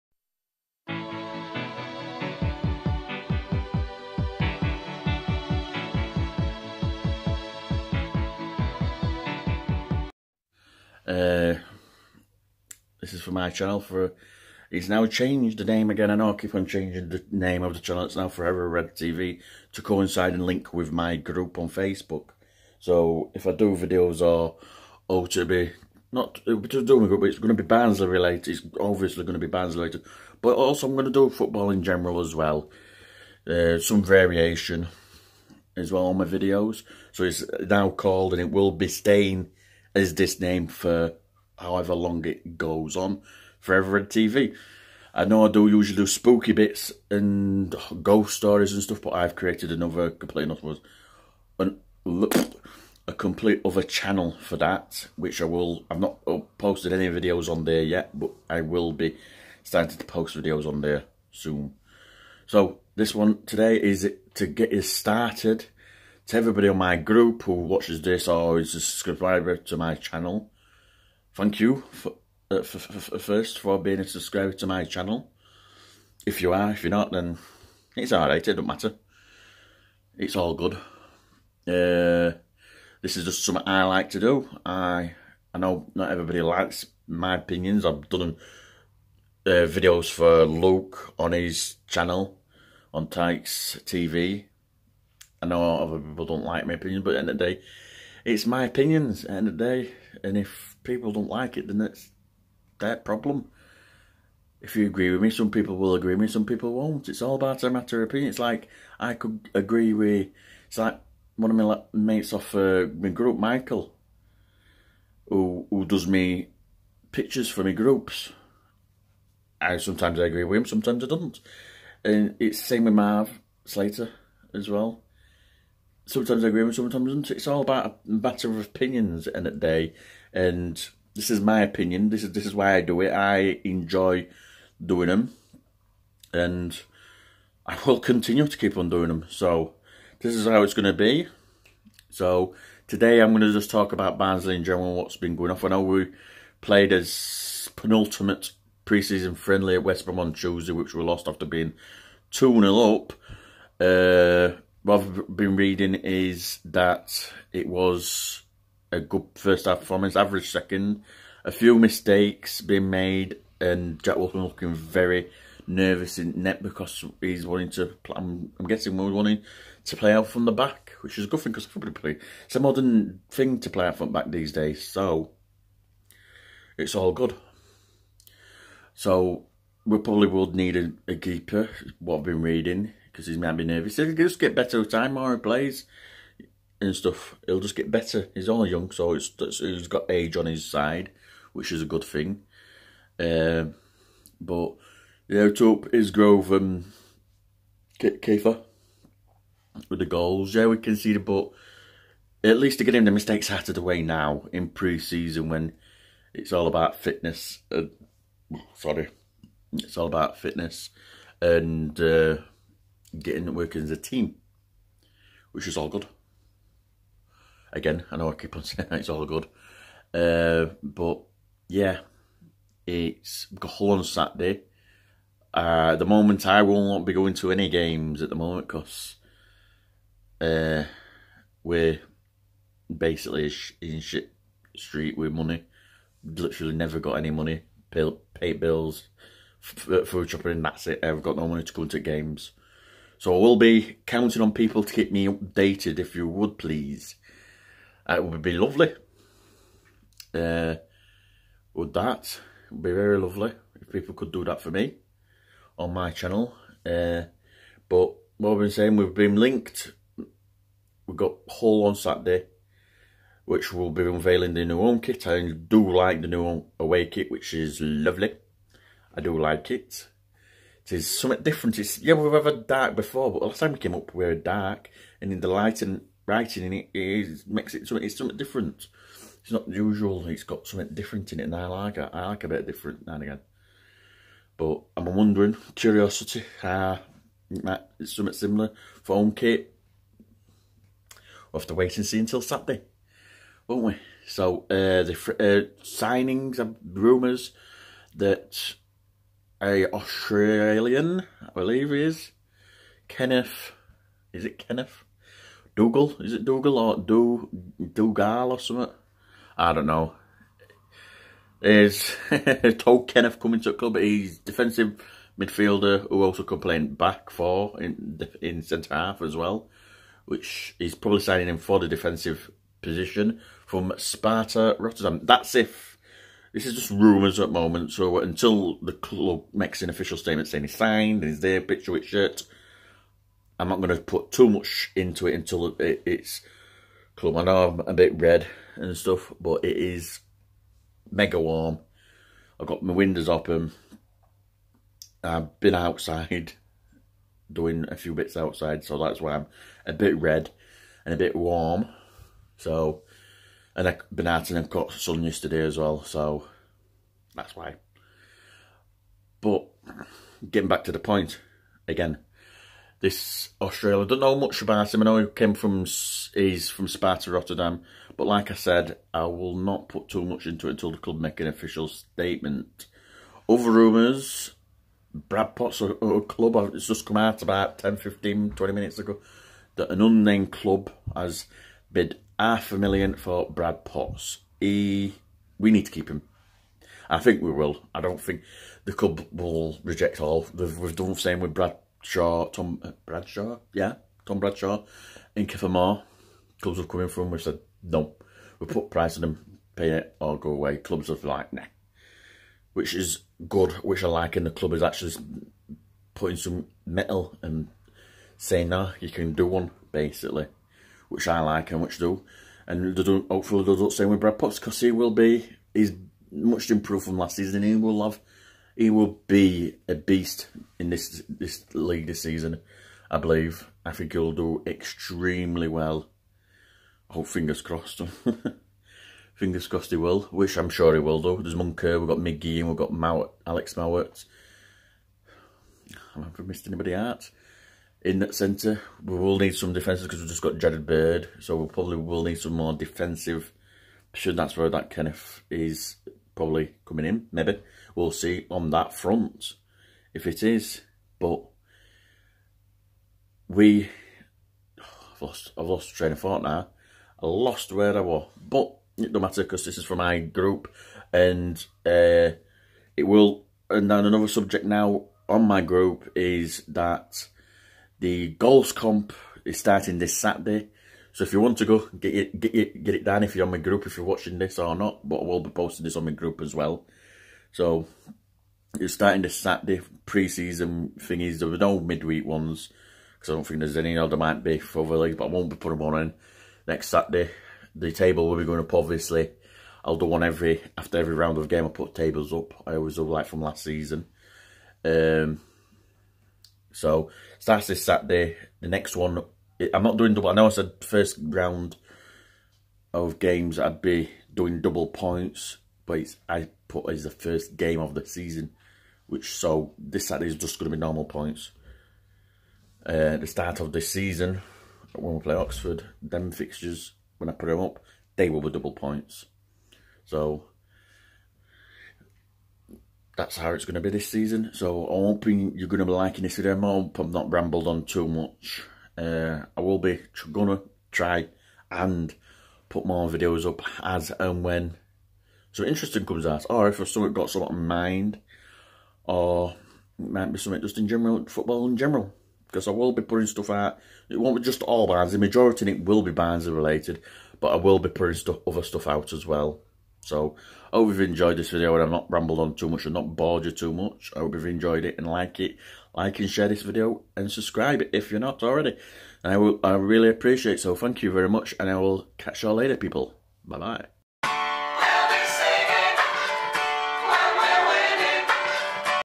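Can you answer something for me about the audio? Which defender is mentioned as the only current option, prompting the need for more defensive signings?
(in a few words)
Jared Bird.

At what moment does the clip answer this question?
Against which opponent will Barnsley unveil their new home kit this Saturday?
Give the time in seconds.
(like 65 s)
261 s.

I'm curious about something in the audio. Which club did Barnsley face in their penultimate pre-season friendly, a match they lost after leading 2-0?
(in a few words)
West Brom.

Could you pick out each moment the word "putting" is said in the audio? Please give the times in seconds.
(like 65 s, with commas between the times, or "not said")
406 s, 485 s, 543 s, 547 s.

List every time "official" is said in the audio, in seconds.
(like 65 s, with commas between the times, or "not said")
329 s, 371 s.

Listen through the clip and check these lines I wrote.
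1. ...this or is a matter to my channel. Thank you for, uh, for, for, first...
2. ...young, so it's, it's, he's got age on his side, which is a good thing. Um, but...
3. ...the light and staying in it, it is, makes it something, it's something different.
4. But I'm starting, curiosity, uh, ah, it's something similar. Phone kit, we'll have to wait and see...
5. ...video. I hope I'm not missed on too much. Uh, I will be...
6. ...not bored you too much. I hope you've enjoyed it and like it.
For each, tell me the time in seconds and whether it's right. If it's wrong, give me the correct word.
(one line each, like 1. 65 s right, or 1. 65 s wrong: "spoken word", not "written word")
1. 68 s wrong: "subscriber", not "matter"
2. 188 s right
3. 275 s wrong: "writing", not "staying"
4. 284 s wrong: "wondering", not "starting"
5. 526 s wrong: "rambled", not "missed"
6. 552 s right.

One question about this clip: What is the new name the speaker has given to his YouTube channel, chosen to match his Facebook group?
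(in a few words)
Forever Red TV.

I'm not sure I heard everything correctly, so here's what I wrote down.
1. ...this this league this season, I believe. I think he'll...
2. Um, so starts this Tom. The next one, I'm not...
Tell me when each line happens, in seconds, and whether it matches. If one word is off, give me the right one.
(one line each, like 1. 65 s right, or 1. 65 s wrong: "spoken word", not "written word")
1. 420 s right
2. 494 s wrong: "Saturday", not "Tom".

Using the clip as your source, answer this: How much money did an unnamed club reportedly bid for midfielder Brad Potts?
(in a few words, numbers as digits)
half a million.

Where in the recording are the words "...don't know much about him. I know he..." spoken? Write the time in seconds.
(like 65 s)
364 s.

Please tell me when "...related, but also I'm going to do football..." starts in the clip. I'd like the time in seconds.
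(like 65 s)
29 s.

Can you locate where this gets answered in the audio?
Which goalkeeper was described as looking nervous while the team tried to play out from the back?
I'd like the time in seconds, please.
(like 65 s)
164 s.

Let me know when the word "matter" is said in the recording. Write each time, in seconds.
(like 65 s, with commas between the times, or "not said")
78 s, 107 s, 128 s, 459 s.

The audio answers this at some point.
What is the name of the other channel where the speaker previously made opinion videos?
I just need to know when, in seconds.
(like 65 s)
93 s.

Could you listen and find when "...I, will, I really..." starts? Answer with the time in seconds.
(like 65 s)
559 s.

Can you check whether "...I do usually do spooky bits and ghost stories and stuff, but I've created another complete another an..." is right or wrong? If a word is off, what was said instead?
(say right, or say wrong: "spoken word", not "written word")
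right.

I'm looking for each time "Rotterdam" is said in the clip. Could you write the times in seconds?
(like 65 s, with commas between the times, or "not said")
324 s, 367 s.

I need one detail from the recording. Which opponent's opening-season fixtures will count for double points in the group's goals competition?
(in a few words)
Oxford.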